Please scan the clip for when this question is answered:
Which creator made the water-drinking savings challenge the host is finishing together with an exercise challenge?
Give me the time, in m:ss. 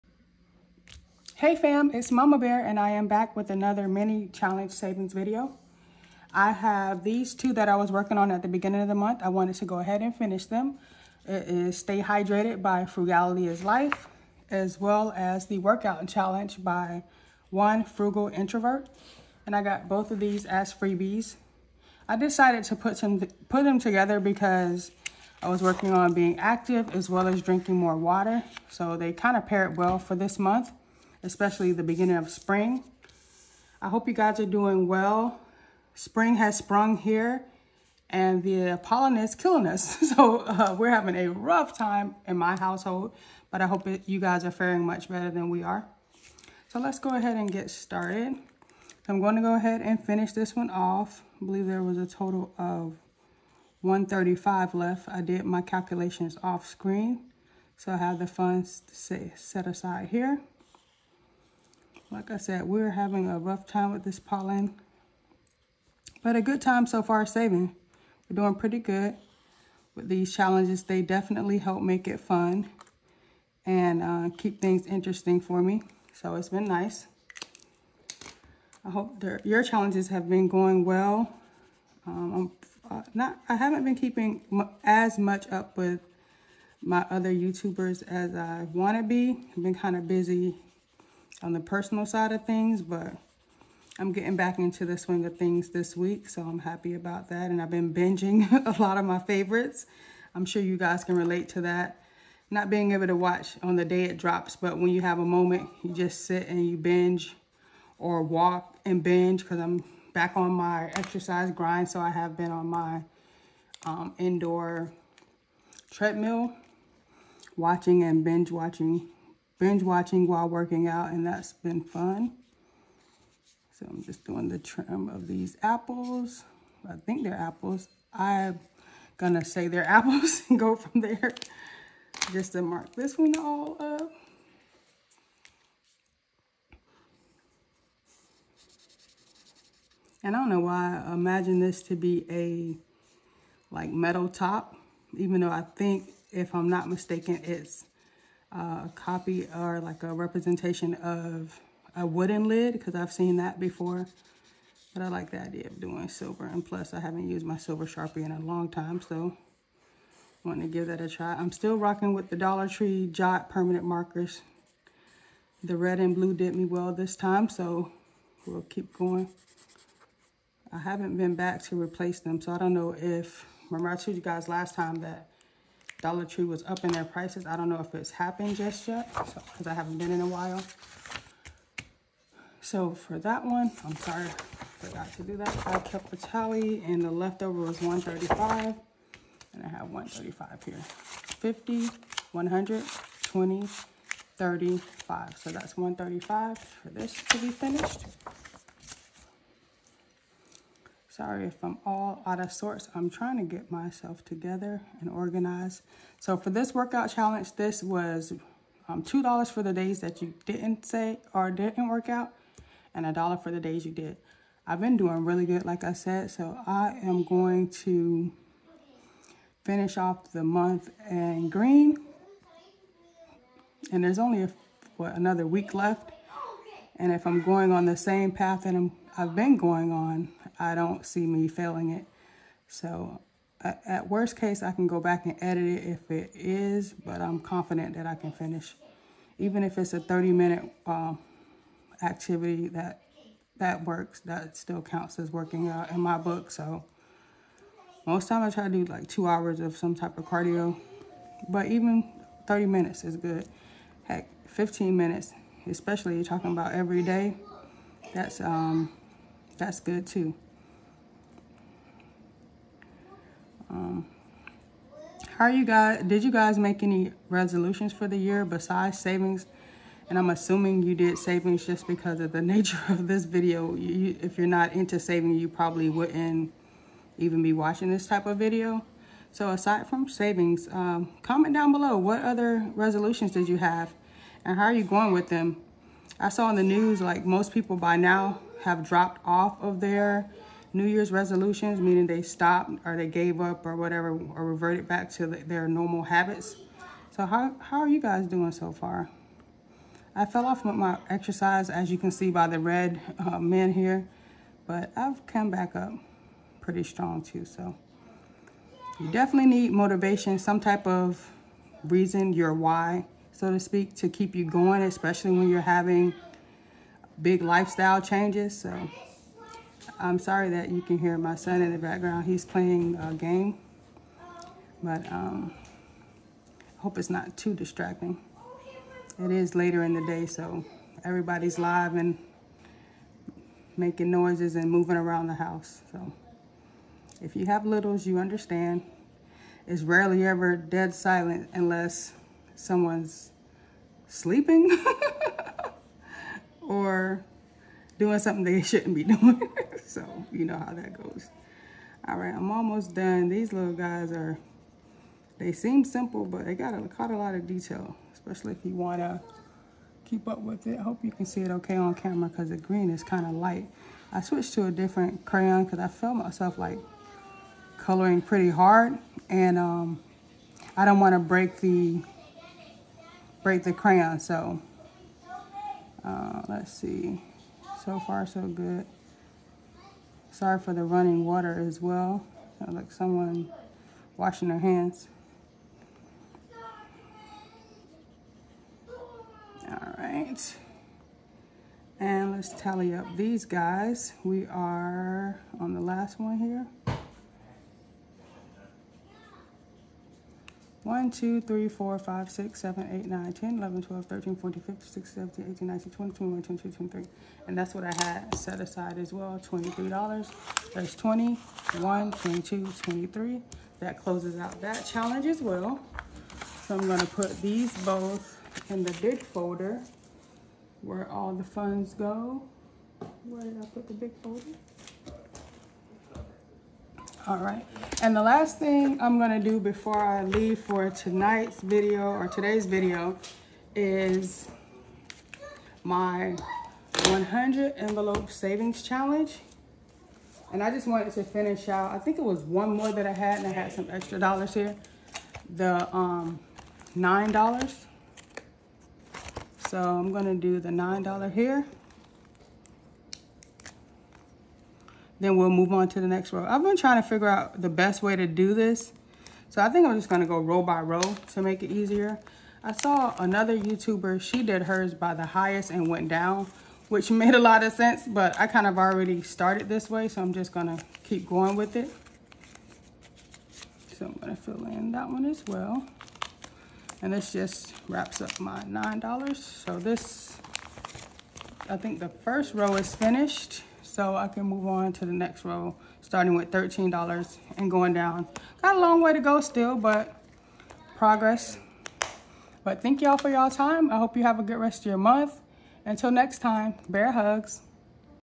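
0:12.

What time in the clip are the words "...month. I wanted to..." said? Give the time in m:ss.
0:08.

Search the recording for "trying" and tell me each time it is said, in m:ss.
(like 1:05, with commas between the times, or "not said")
3:23, 7:36.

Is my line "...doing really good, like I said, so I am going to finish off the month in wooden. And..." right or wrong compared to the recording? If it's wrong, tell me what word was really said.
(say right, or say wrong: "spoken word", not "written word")
wrong: "green", not "wooden".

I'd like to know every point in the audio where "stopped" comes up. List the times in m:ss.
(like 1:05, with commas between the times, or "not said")
4:52.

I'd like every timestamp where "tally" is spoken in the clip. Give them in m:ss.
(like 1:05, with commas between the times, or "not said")
3:06, 6:32.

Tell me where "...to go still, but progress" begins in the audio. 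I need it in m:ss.
8:09.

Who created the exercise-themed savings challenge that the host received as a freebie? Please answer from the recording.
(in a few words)
One Frugal Introvert.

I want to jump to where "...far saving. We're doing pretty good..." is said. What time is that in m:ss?
1:07.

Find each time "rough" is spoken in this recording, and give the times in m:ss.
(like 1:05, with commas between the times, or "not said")
0:41, 1:03.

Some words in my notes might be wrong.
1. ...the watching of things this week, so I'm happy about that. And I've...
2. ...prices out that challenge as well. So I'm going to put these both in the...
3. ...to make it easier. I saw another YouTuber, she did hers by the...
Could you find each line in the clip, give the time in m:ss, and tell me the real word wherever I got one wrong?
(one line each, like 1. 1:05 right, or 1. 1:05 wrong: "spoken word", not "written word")
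1. 1:34 wrong: "swing", not "watching"
2. 6:54 wrong: "closes", not "prices"
3. 7:41 right.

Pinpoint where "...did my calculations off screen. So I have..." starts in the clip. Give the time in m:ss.
0:55.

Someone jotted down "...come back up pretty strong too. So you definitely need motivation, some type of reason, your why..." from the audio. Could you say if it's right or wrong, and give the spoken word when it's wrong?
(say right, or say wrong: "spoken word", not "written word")
right.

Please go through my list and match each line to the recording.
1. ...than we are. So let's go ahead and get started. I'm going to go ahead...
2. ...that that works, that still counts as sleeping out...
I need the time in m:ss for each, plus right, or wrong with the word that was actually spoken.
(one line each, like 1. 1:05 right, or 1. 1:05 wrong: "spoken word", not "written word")
1. 0:45 right
2. 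4:02 wrong: "working", not "sleeping".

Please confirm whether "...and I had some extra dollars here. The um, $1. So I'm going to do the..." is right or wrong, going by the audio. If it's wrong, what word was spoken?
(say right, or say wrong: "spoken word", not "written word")
wrong: "9", not "1".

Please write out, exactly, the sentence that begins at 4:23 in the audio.
Um, how you guys, did you guys make any resolutions for the year besides savings?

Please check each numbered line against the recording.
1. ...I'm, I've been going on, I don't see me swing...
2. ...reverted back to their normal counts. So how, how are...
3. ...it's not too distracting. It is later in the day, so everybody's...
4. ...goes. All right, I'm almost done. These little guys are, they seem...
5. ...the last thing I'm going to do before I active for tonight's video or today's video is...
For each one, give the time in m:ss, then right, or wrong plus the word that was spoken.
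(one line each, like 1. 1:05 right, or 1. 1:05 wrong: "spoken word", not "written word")
1. 3:48 wrong: "failing", not "swing"
2. 4:54 wrong: "habits", not "counts"
3. 5:26 right
4. 5:51 right
5. 7:08 wrong: "leave", not "active".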